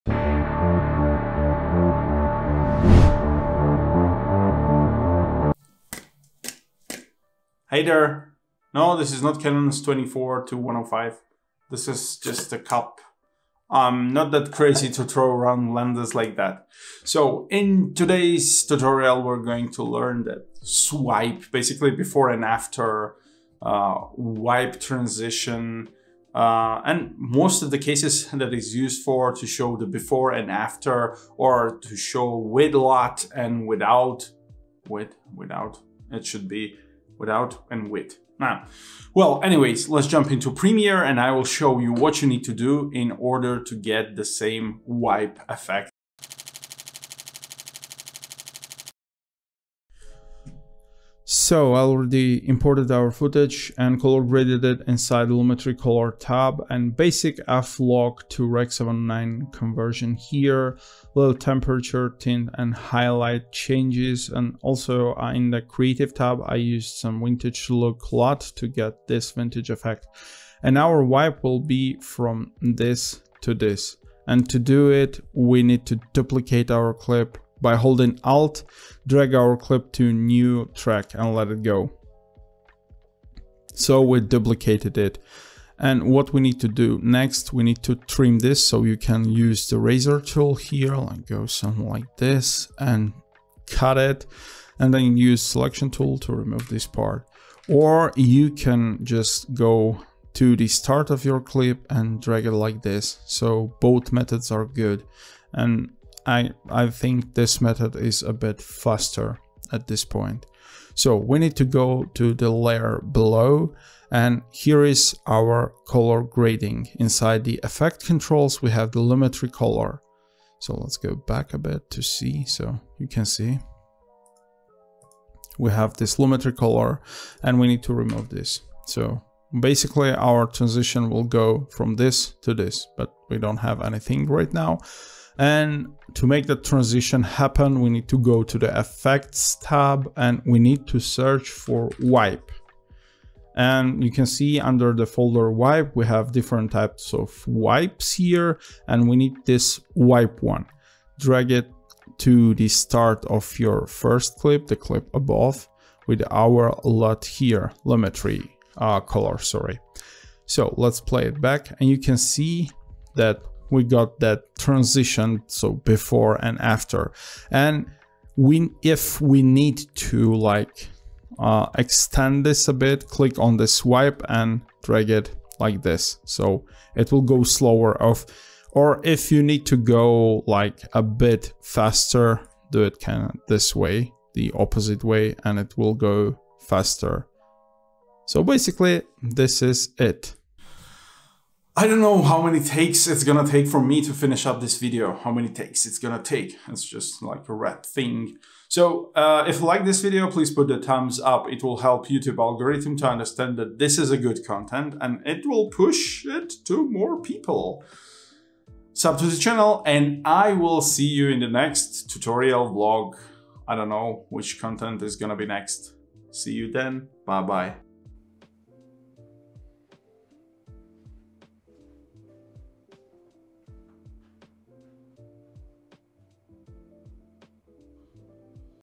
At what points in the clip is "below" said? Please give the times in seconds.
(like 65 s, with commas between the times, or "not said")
113 s.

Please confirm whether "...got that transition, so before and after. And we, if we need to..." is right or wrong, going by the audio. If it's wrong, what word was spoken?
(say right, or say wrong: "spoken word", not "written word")
right.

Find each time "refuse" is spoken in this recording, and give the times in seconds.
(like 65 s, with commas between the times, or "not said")
not said.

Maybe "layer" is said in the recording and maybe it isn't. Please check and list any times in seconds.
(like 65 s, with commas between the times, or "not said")
112 s.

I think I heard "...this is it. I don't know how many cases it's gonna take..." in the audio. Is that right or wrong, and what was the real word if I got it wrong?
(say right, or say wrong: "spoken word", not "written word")
wrong: "takes", not "cases".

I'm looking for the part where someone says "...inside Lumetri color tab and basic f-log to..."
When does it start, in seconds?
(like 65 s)
54 s.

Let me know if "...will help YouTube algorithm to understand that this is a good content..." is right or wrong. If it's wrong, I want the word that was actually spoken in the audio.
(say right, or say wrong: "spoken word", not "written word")
right.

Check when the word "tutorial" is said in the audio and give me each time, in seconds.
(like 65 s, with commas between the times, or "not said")
18 s, 212 s.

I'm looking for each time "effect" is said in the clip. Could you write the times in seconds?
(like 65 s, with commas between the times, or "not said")
45 s, 69 s, 117 s, 138 s.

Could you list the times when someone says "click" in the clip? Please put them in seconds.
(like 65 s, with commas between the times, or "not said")
173 s.